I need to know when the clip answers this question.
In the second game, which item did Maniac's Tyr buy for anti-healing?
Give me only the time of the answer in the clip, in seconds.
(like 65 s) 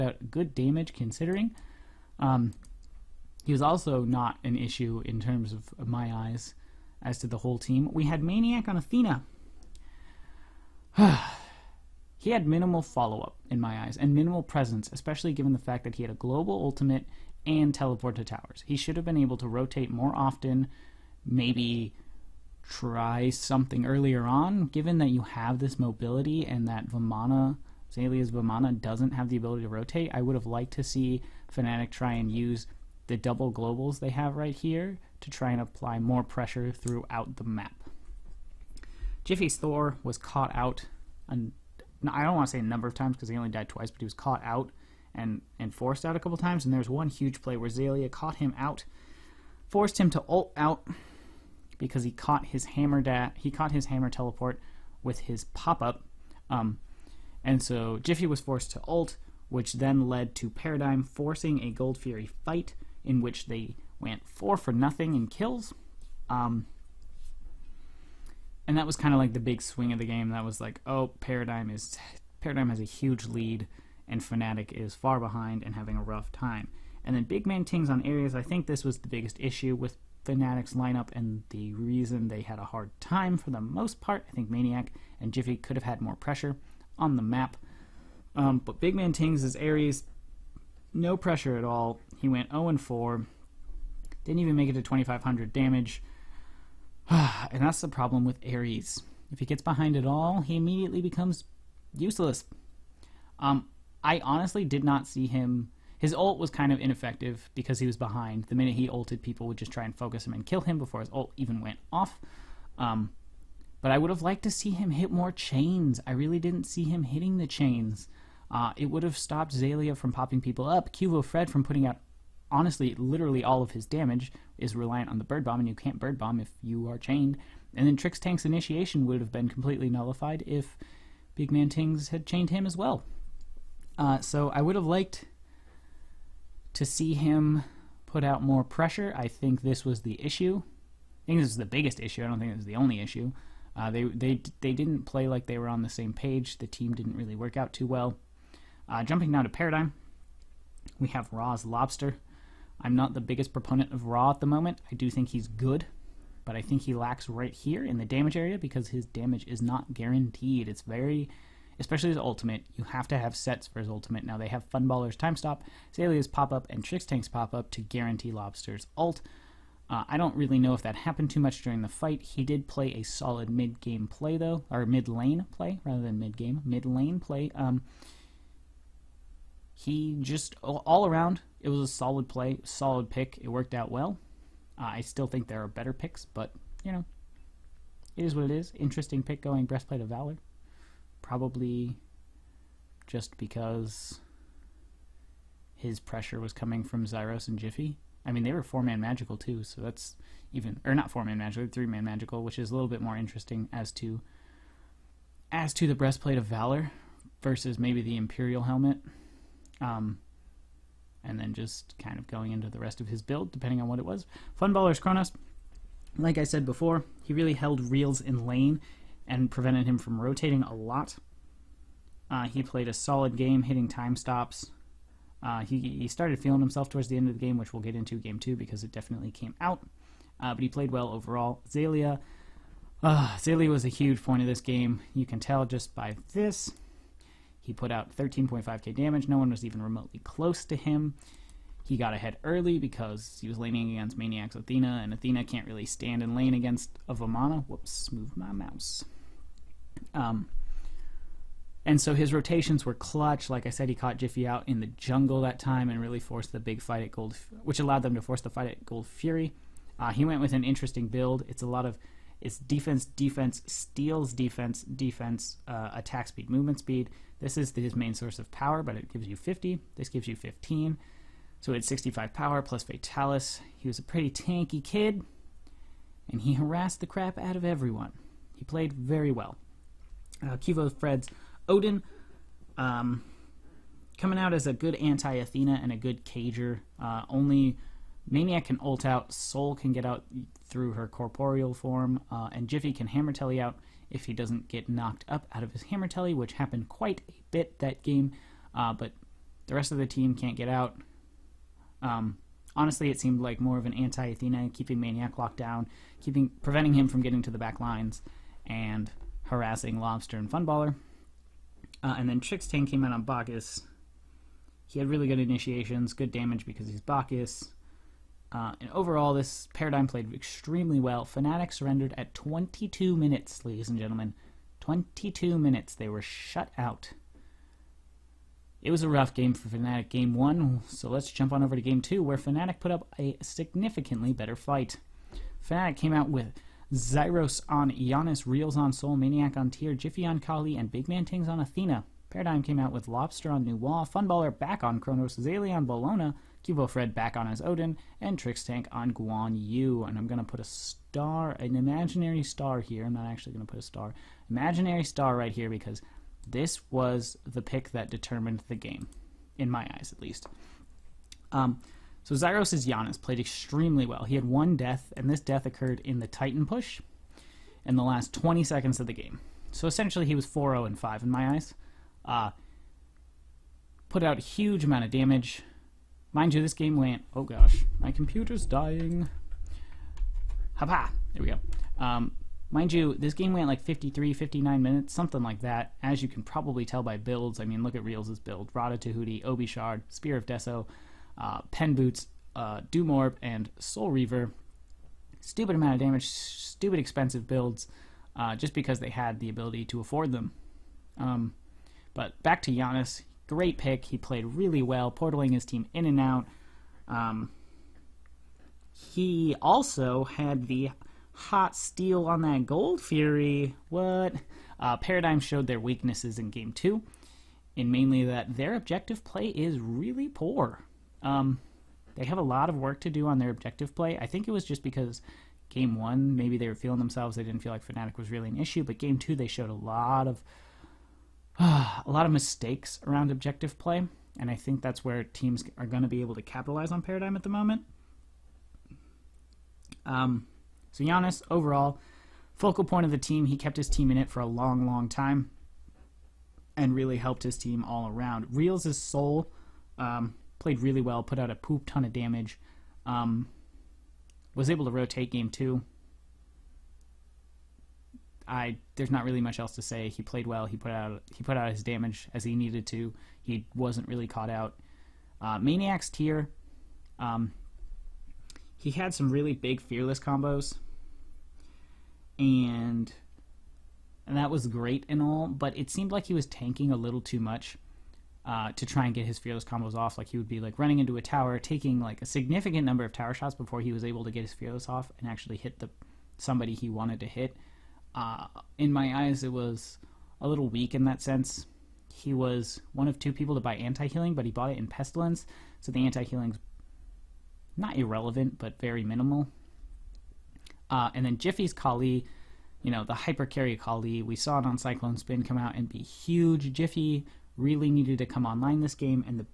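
494 s.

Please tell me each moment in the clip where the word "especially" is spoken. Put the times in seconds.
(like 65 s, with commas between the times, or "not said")
14 s, 161 s.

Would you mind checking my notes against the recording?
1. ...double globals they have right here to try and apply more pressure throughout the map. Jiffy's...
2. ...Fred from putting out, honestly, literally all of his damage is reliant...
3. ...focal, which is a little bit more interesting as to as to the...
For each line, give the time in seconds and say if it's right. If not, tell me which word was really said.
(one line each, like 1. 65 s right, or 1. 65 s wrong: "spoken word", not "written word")
1. 33 s right
2. 121 s right
3. 202 s wrong: "magical", not "focal".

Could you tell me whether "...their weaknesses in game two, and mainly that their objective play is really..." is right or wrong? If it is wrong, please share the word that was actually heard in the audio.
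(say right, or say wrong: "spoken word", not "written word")
right.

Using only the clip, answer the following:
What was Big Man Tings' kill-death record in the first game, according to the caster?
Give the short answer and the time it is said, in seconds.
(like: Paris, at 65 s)
0 and 4, at 92 s.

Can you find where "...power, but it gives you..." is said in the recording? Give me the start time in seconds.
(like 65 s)
268 s.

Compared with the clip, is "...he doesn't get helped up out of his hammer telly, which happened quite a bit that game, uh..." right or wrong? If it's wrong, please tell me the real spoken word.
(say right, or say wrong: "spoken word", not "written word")
wrong: "knocked", not "helped".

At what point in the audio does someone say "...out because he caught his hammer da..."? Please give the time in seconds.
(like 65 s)
50 s.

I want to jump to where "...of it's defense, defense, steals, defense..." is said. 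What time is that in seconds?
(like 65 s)
261 s.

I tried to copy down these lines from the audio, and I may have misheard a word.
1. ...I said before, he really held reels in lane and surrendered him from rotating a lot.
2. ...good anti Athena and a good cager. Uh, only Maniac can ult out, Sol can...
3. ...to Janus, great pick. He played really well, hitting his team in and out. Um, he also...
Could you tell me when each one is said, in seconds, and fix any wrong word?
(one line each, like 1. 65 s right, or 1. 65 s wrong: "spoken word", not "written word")
1. 216 s wrong: "prevented", not "surrendered"
2. 284 s right
3. 402 s wrong: "portaling", not "hitting".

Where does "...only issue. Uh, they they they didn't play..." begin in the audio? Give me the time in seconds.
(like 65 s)
142 s.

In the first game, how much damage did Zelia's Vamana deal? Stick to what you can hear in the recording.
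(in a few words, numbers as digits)
13.5k.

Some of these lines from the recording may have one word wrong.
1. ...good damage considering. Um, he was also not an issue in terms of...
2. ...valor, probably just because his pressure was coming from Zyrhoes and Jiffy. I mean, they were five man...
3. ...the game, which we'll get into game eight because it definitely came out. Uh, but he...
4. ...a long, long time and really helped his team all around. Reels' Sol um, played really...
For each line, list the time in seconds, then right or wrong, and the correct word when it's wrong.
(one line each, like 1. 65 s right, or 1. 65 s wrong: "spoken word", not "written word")
1. 0 s right
2. 190 s wrong: "four", not "five"
3. 227 s wrong: "two", not "eight"
4. 444 s right.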